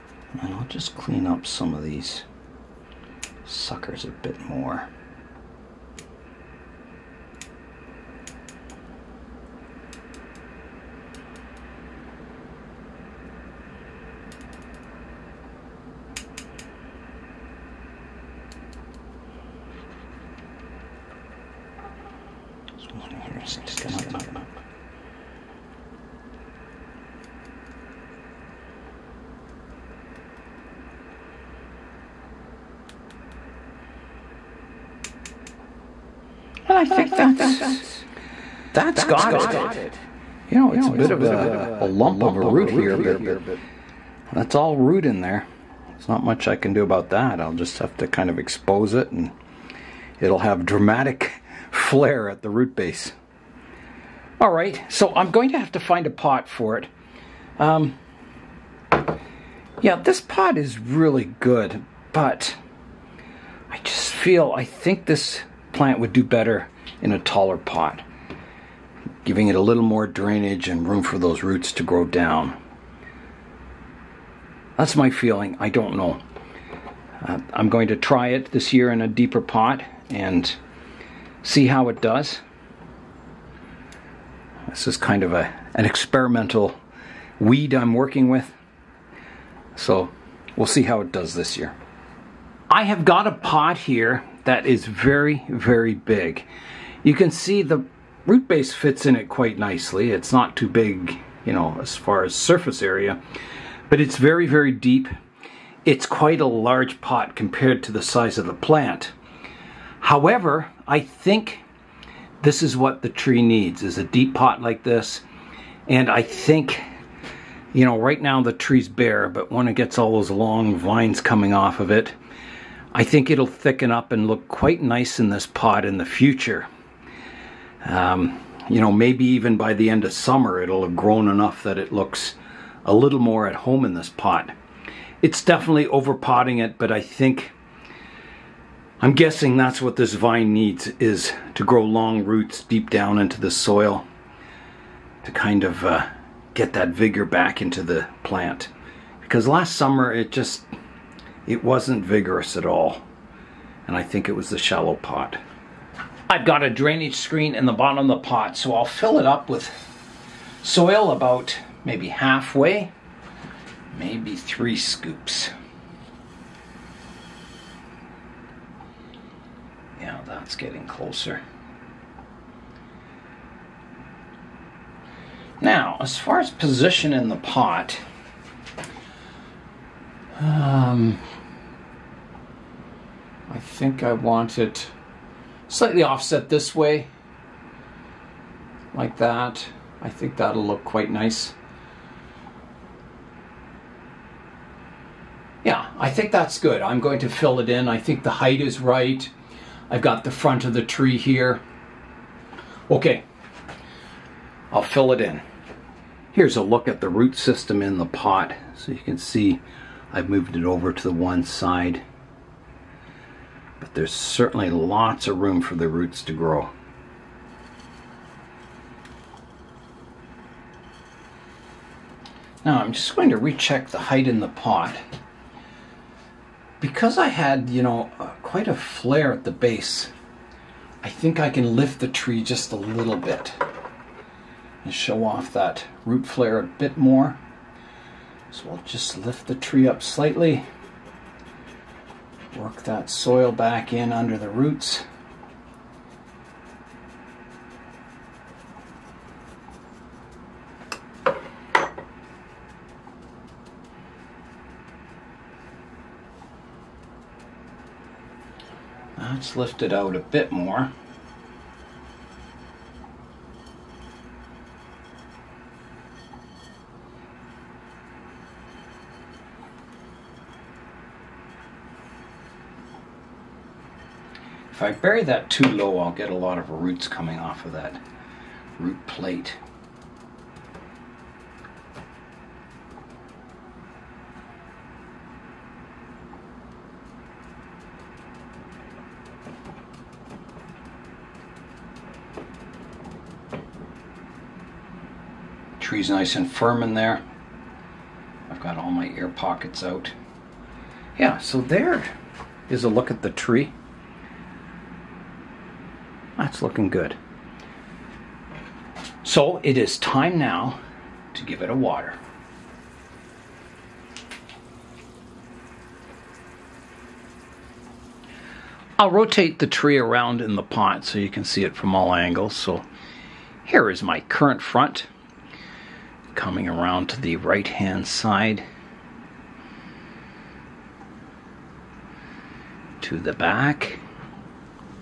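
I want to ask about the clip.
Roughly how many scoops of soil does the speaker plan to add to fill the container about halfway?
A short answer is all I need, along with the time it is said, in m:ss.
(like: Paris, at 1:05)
3, at 2:44.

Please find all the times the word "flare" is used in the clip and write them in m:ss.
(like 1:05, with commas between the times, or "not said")
0:51, 3:48, 3:56.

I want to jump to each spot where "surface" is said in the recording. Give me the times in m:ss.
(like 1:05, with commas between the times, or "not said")
1:42.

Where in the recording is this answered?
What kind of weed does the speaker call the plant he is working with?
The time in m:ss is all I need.
1:25.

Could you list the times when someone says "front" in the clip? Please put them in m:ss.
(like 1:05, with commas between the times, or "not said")
3:20, 5:24.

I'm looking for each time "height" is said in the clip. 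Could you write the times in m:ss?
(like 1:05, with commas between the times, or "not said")
3:18, 3:43.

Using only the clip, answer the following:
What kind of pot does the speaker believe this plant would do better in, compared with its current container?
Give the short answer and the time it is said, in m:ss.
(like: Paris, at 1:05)
a taller pot, at 1:06.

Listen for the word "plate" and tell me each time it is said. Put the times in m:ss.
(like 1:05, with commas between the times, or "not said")
4:39.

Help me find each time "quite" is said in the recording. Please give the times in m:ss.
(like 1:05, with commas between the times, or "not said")
1:39, 1:46, 2:04, 3:10, 3:48.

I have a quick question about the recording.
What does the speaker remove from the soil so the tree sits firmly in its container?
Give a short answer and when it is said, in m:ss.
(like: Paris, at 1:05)
air pockets, at 4:59.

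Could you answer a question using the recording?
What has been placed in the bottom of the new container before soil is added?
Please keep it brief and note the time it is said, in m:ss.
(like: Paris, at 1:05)
a drainage screen, at 2:36.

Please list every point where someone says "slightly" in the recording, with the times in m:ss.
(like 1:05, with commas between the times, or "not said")
3:05, 4:00.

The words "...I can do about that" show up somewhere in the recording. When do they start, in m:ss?
0:46.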